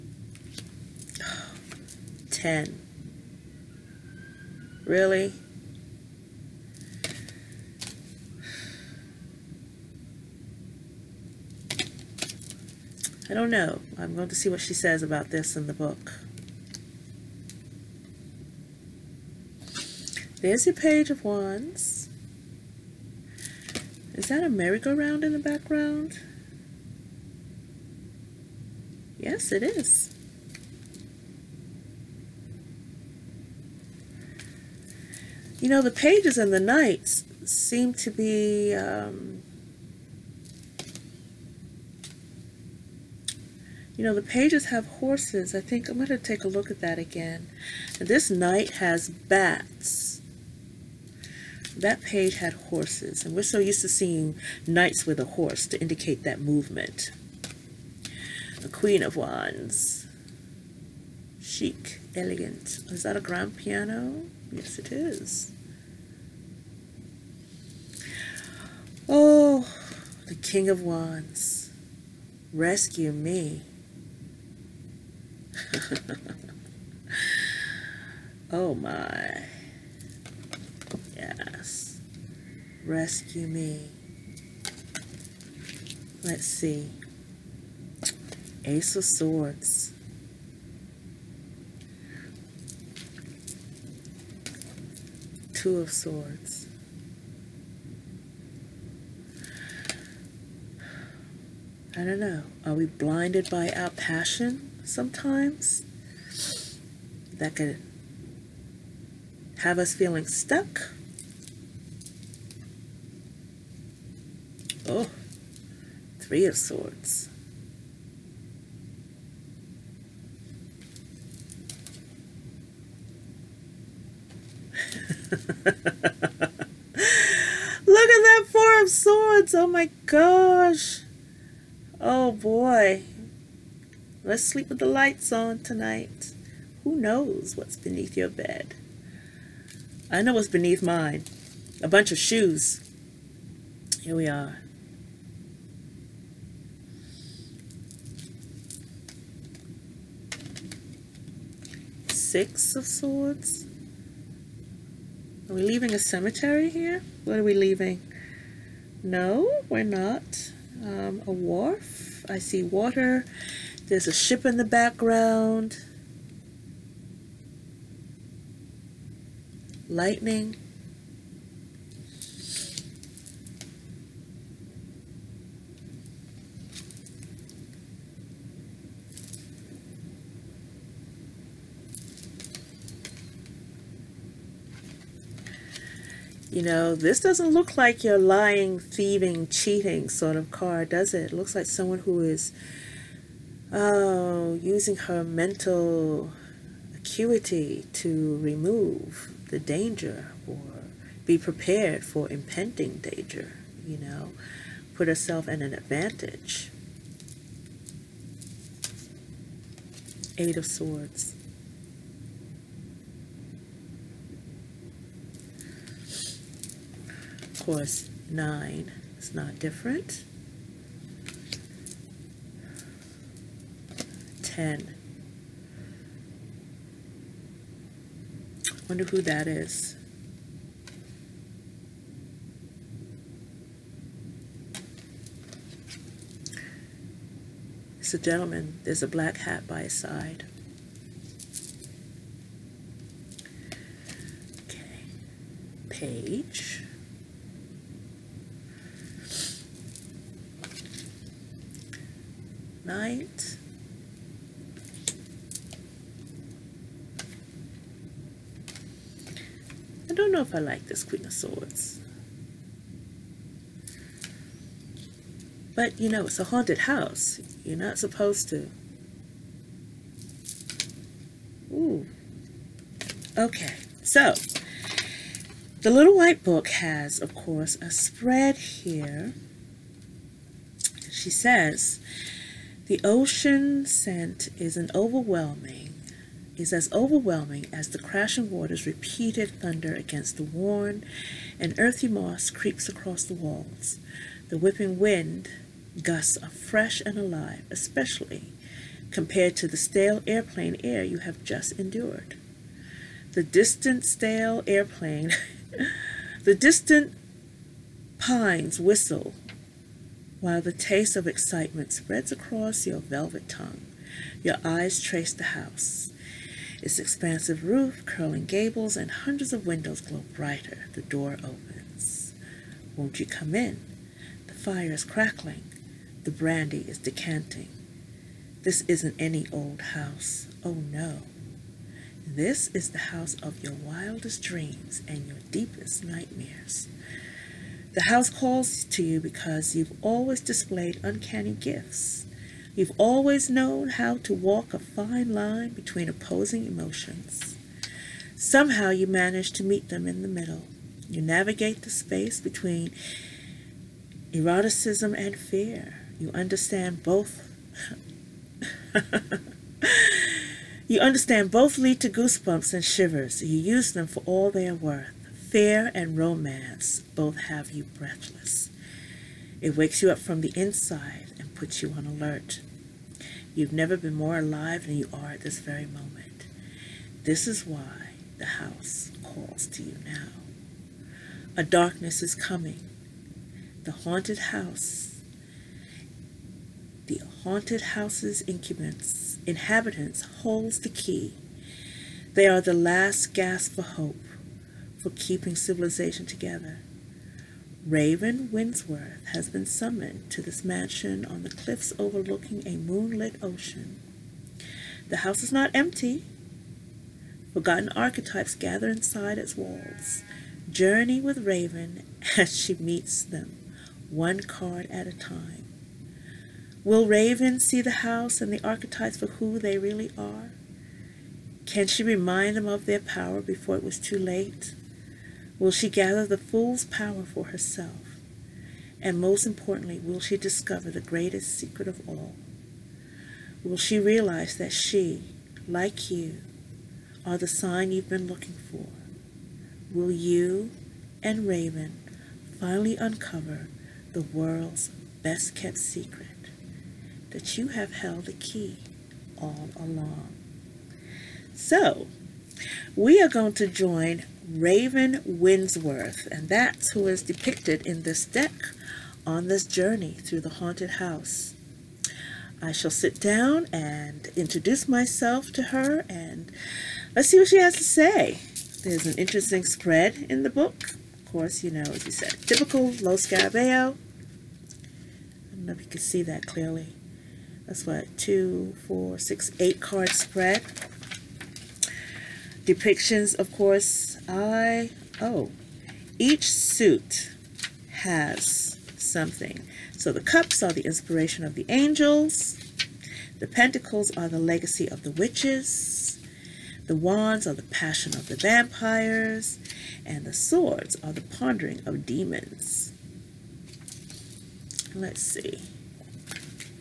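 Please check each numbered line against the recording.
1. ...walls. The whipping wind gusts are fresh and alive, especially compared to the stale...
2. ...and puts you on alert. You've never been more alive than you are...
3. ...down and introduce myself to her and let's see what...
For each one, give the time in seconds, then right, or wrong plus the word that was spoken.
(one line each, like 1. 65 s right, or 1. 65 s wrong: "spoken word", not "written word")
1. 293 s right
2. 371 s right
3. 463 s right.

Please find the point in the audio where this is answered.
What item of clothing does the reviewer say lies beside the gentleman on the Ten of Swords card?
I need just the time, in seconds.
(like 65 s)
239 s.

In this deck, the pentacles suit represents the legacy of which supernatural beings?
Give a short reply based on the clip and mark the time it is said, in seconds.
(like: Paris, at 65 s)
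Witches, at 495 s.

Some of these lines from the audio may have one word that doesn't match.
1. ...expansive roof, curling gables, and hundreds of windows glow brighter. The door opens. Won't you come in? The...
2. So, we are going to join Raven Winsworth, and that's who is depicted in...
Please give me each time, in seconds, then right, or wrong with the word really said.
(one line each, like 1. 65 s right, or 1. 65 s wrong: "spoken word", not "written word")
1. 316 s right
2. 451 s right.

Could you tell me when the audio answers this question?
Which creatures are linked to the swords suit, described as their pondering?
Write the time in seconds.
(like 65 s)
502 s.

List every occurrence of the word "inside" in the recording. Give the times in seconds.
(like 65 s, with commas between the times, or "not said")
370 s, 408 s.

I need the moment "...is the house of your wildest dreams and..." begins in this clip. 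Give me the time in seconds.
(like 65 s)
332 s.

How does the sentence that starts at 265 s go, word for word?
But, you know, it's a haunted house.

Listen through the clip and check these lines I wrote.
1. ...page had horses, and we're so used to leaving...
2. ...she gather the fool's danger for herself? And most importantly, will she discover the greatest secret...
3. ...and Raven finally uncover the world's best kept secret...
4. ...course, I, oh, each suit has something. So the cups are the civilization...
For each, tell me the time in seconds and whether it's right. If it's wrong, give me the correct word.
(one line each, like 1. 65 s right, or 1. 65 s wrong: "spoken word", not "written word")
1. 52 s wrong: "seeing", not "leaving"
2. 425 s wrong: "power", not "danger"
3. 441 s right
4. 483 s wrong: "inspiration", not "civilization".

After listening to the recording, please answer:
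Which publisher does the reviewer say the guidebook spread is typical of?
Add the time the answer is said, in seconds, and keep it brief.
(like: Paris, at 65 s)
Lo Scarabeo, at 472 s.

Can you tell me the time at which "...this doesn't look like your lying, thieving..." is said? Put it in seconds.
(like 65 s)
186 s.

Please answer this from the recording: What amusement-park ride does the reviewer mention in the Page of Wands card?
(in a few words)
Merry-go-round.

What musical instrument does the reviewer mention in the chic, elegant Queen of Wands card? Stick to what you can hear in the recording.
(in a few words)
Grand piano.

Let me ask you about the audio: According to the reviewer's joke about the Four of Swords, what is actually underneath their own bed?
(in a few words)
A bunch of shoes.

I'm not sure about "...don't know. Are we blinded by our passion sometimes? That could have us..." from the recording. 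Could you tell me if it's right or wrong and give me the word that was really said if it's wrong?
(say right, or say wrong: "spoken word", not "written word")
right.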